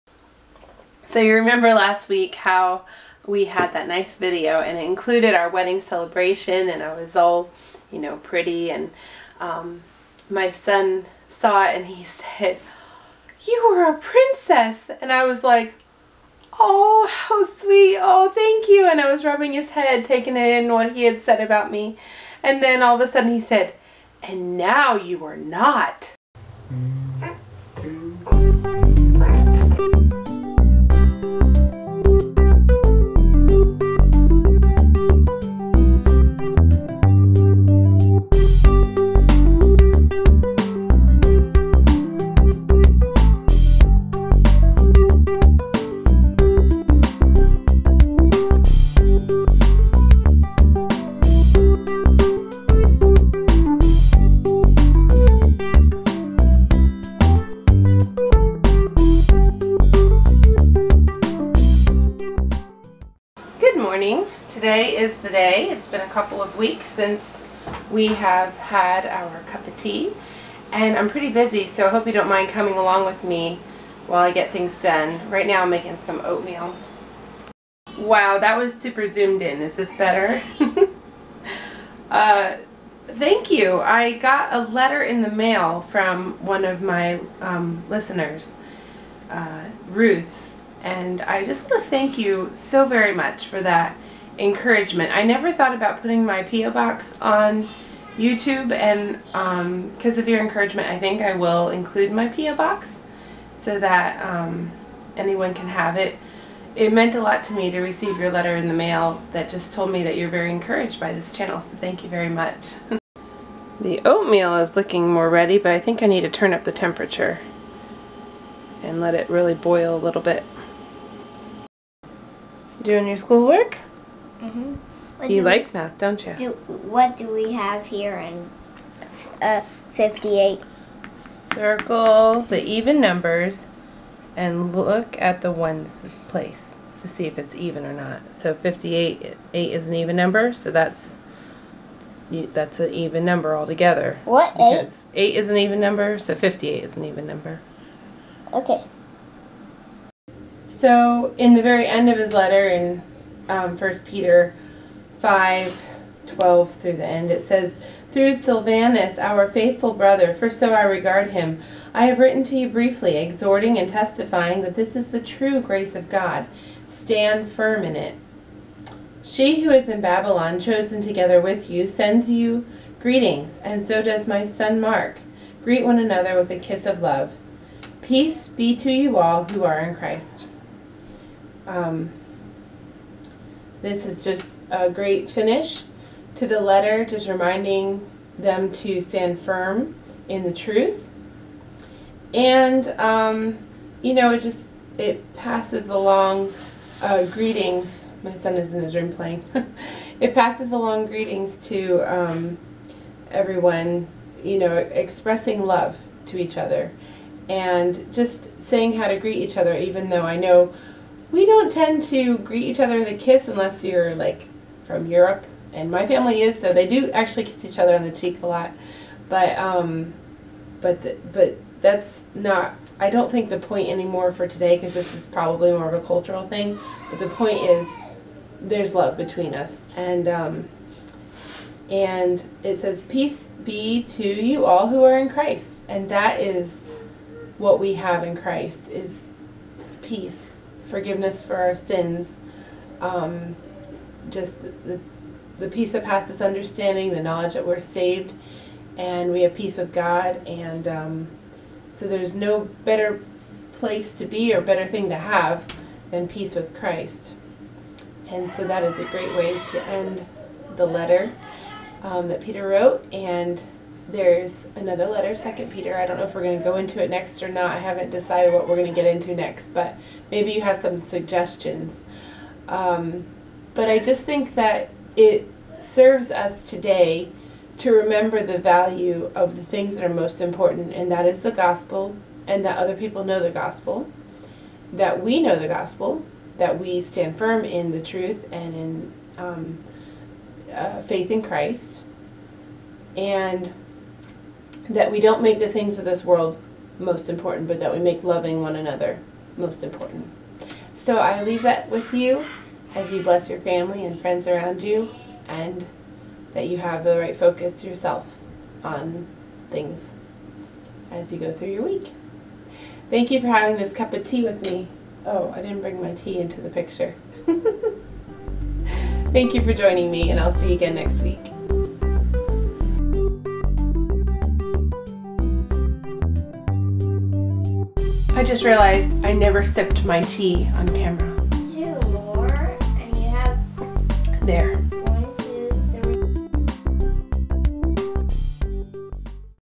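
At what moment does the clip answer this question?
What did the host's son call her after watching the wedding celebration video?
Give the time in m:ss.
0:13.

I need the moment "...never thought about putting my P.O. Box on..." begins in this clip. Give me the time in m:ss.
1:35.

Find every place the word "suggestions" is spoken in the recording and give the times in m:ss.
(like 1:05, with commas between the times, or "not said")
4:30.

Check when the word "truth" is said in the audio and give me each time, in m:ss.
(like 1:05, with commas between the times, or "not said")
3:10, 4:48.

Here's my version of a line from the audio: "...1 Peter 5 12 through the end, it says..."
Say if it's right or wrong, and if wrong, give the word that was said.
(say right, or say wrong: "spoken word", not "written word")
right.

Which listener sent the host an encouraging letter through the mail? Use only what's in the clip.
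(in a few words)
Ruth.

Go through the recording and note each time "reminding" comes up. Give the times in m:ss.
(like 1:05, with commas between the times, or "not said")
3:07.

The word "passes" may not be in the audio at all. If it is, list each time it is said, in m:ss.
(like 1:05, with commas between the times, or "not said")
3:15, 3:20, 4:06.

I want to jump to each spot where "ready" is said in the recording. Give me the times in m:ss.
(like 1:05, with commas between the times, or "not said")
1:55.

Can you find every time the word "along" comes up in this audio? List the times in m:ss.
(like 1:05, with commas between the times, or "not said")
1:12, 3:15, 3:20.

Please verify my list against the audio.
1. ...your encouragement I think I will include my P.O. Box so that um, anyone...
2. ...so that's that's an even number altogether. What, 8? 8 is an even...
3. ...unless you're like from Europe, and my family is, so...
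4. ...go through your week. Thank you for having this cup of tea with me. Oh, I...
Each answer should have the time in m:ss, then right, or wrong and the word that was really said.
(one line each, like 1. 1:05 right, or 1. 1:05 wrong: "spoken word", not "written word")
1. 1:40 right
2. 2:20 right
3. 3:33 right
4. 5:11 right.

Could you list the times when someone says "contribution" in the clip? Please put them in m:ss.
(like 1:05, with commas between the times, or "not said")
not said.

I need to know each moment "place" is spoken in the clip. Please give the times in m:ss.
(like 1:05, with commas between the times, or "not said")
2:16, 4:13.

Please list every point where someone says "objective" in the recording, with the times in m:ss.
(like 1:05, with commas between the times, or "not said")
not said.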